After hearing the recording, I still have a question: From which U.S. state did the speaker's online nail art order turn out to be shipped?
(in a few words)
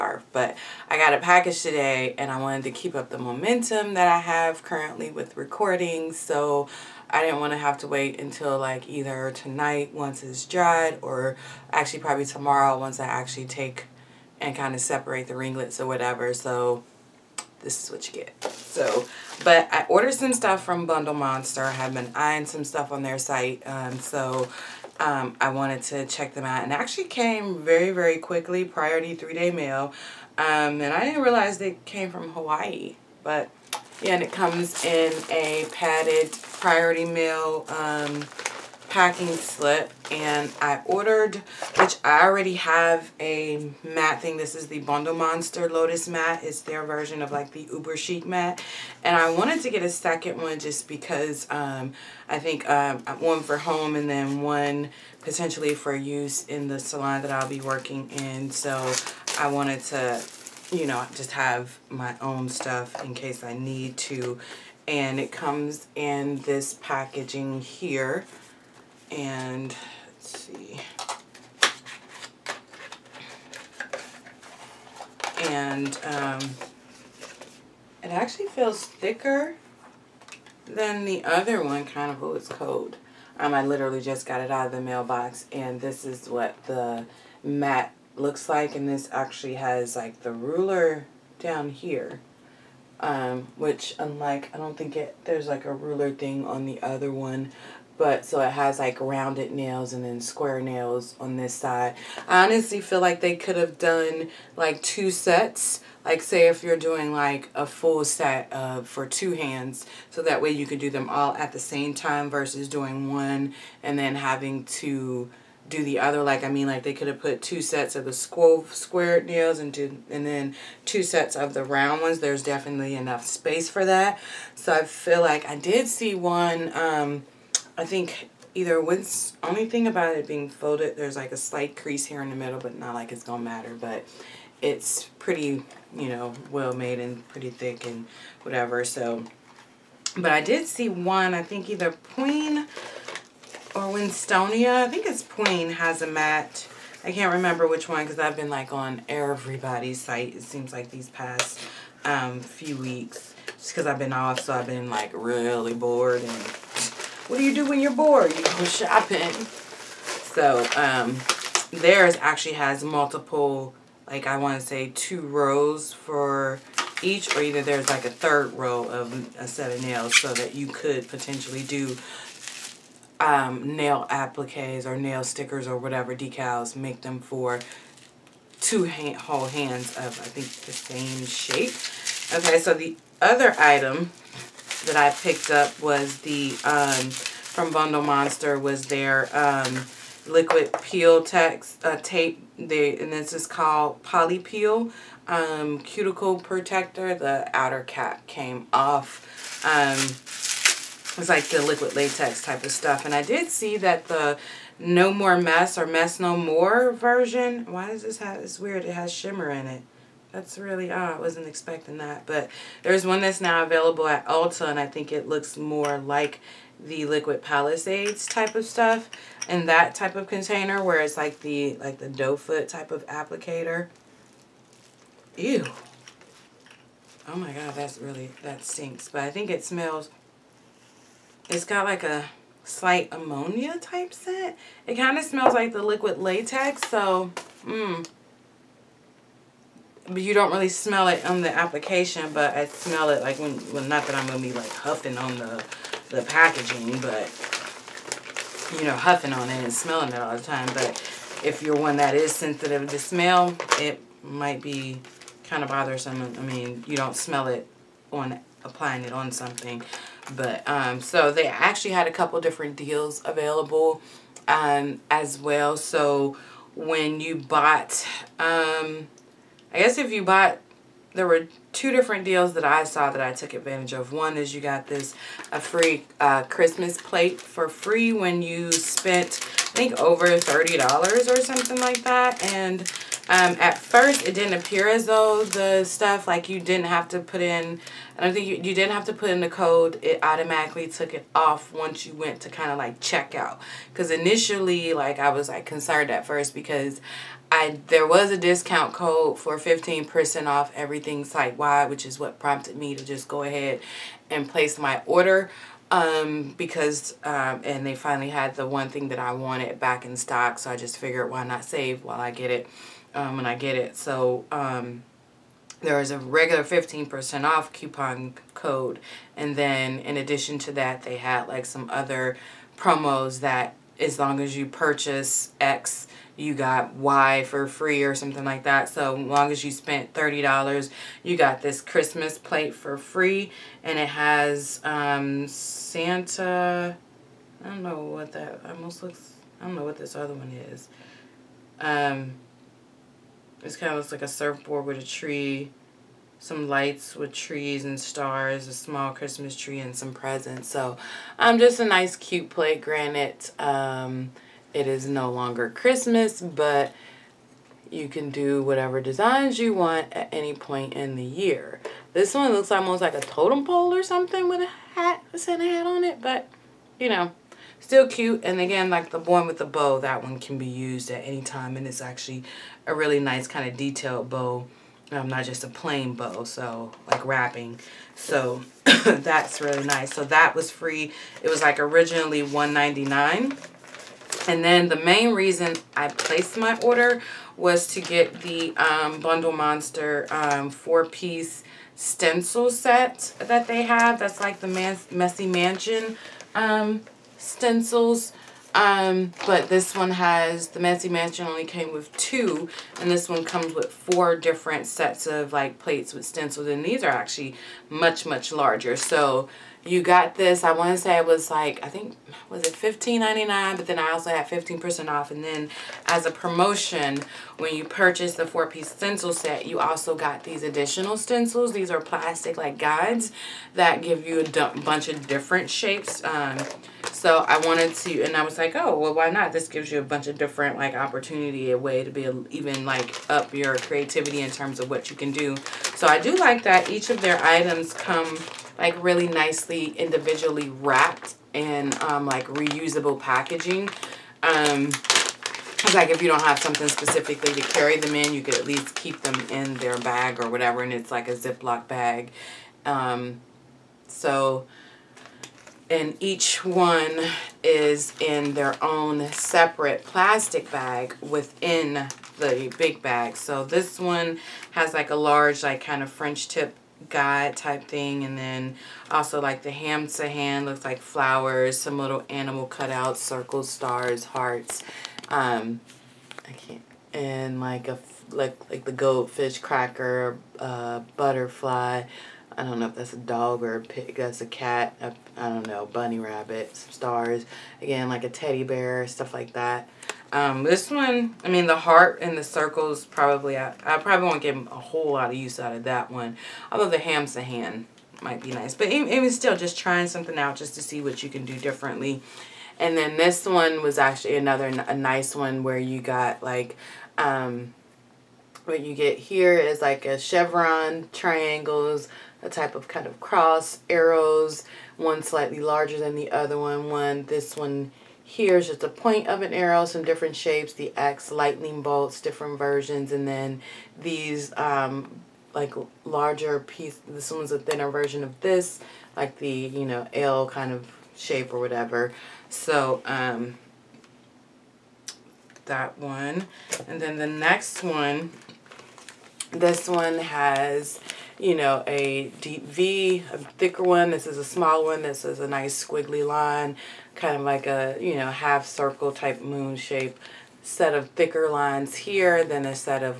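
Hawaii.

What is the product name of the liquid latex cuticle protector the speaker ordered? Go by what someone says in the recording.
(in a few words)
Poli-Peel.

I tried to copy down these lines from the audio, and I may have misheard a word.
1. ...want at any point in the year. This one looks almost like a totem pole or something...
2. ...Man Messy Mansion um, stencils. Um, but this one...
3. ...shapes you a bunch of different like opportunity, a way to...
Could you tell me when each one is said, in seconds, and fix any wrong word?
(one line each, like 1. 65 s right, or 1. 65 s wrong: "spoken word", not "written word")
1. 359 s right
2. 394 s right
3. 429 s wrong: "gives", not "shapes".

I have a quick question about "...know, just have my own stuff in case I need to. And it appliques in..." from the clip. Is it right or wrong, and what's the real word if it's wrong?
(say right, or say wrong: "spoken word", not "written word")
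wrong: "comes", not "appliques".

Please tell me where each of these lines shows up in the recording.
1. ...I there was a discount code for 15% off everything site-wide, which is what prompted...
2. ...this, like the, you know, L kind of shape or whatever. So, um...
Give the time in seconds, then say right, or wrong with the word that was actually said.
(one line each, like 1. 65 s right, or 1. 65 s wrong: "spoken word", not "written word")
1. 297 s right
2. 528 s right.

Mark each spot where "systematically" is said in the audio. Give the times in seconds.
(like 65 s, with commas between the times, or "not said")
not said.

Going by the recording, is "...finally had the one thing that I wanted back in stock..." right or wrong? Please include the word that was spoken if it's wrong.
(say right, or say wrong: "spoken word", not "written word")
right.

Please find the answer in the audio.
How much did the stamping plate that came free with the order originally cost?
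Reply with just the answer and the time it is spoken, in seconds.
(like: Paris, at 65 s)
$1.99, at 382 s.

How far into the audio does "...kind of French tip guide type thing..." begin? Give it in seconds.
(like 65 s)
465 s.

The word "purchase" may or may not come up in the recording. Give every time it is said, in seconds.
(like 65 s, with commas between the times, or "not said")
324 s, 417 s.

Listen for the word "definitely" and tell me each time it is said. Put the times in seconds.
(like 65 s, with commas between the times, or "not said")
122 s.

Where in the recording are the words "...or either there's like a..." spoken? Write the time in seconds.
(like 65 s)
167 s.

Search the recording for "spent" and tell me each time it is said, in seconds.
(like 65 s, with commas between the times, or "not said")
278 s, 329 s.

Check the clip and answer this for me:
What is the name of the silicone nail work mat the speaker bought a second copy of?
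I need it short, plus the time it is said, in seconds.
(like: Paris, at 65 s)
Lotus Matte, at 45 s.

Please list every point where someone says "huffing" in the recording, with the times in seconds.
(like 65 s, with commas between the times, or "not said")
244 s, 248 s.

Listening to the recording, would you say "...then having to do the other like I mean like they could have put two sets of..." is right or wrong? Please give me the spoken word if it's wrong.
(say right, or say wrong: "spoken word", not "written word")
right.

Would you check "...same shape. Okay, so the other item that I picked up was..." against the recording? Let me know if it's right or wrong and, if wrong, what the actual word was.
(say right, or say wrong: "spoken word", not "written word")
right.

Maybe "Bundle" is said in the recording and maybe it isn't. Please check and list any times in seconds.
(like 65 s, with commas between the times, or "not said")
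20 s, 44 s, 187 s, 389 s.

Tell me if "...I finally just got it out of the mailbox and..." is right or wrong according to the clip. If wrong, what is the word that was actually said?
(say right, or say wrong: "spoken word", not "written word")
wrong: "literally", not "finally".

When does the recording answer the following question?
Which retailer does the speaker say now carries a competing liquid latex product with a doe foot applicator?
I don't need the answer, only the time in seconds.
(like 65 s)
214 s.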